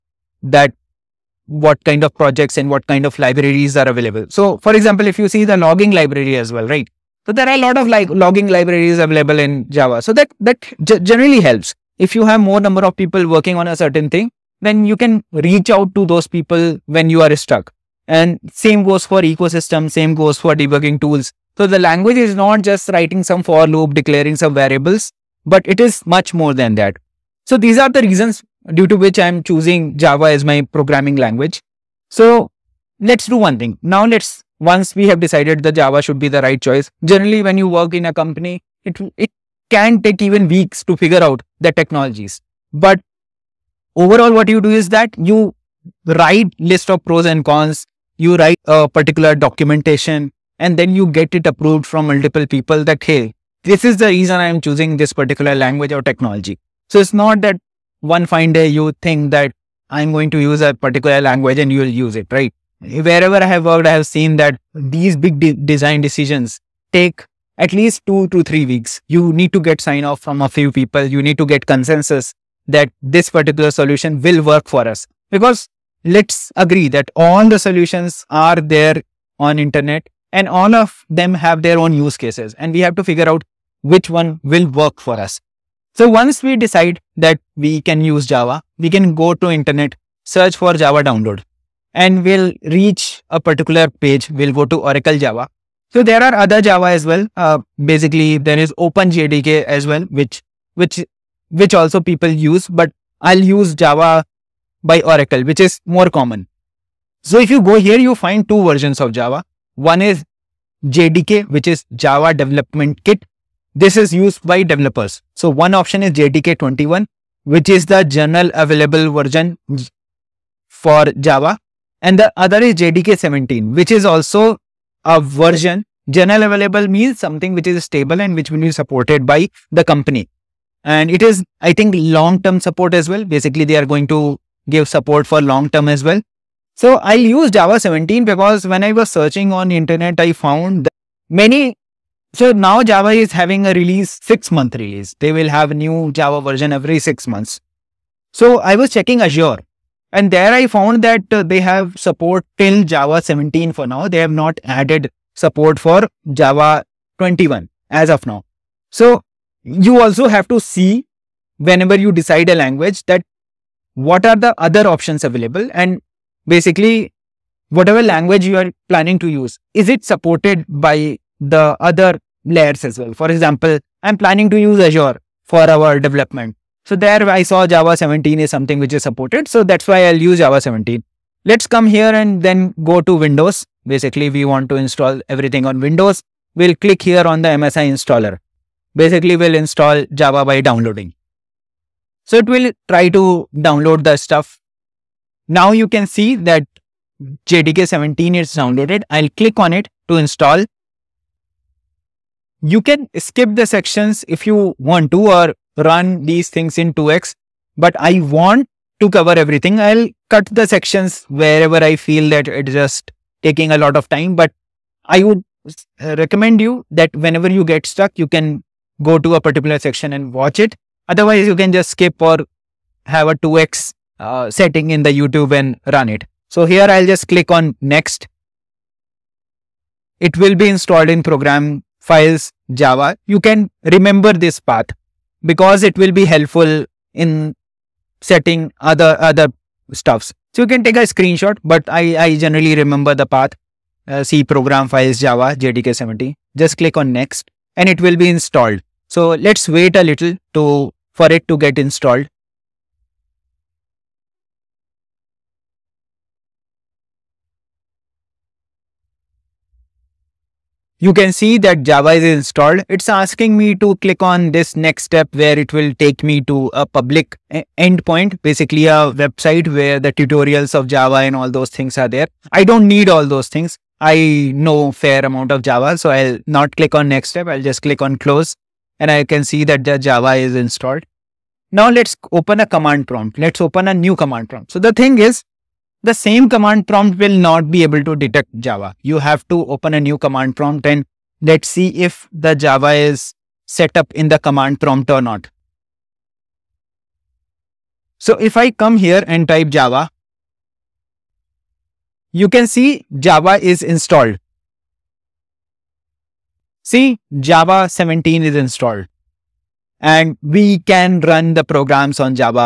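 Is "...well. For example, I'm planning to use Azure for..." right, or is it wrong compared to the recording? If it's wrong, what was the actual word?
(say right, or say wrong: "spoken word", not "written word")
right.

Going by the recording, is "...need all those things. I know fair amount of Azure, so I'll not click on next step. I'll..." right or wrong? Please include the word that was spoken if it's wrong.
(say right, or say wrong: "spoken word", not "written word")
wrong: "Java", not "Azure".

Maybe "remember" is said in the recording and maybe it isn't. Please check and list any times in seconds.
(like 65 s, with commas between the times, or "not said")
233 s, 242 s.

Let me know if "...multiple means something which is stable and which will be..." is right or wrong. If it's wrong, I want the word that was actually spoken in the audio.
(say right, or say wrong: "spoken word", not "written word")
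wrong: "available", not "multiple".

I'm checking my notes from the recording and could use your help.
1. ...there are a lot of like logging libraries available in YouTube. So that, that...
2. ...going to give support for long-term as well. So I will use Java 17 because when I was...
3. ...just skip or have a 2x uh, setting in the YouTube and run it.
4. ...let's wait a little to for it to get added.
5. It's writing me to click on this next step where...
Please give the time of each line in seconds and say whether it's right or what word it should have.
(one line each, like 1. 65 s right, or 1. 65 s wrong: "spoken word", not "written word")
1. 7 s wrong: "Java", not "YouTube"
2. 133 s right
3. 221 s right
4. 249 s wrong: "installed", not "added"
5. 262 s wrong: "asking", not "writing".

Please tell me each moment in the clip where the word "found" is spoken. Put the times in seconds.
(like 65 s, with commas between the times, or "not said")
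140 s, 150 s.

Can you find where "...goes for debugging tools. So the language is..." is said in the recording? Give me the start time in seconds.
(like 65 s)
20 s.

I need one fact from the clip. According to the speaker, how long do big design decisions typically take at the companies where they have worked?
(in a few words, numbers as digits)
2 to 3 weeks.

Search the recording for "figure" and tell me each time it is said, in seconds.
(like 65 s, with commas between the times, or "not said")
40 s, 83 s.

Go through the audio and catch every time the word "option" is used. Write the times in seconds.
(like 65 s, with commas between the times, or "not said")
115 s, 164 s.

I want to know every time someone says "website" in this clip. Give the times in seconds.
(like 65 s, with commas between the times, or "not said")
269 s.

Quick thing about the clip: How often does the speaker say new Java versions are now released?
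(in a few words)
Every 6 months.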